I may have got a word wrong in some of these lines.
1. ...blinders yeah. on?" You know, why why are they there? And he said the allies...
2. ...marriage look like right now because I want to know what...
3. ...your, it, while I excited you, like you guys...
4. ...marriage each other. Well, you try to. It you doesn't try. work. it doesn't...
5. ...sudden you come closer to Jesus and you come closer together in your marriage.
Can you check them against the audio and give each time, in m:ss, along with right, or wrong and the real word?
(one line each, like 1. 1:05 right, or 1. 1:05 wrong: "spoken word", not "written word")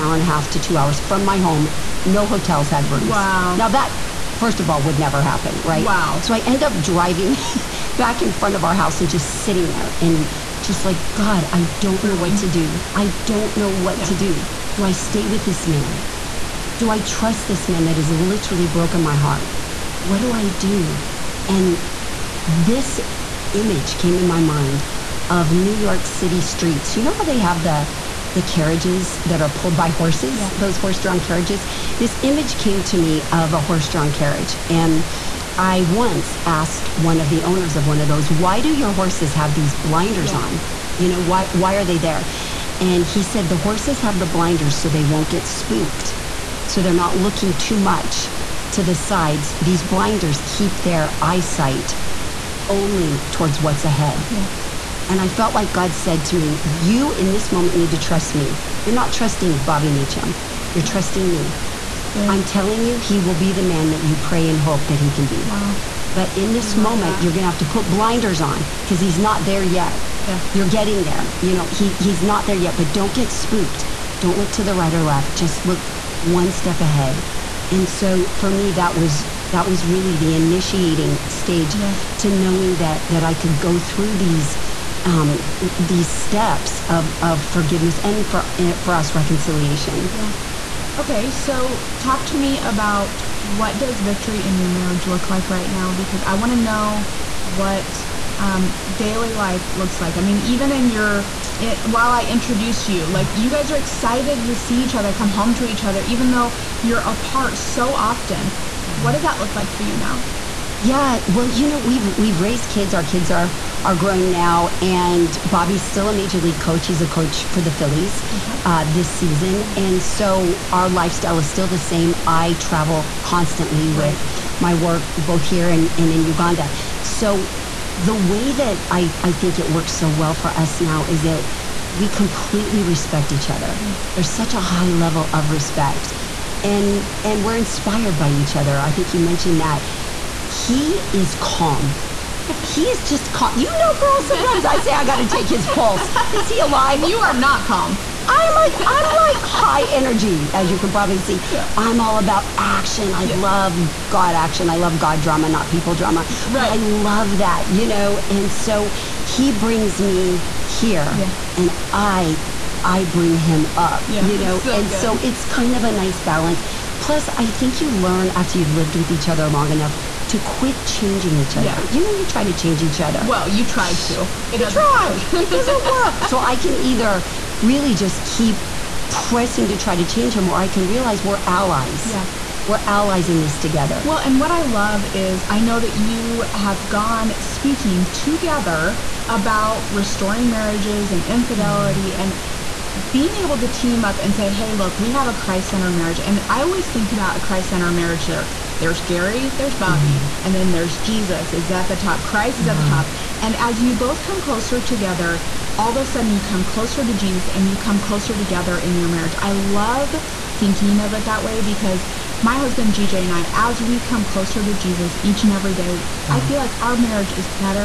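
1. 0:39 wrong: "horses", not "allies"
2. 1:34 right
3. 1:40 wrong: "introduced", not "excited"
4. 2:52 wrong: "change", not "marriage"
5. 3:26 right.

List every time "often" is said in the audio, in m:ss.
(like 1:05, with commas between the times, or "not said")
1:47.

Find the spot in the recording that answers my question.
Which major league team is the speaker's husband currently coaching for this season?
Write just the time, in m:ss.
1:57.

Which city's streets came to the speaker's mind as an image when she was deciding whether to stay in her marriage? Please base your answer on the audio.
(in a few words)
New York City.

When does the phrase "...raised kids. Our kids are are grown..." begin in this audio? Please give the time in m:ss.
1:52.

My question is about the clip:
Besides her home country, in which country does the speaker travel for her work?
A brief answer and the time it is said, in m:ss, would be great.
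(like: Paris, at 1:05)
Uganda, at 2:06.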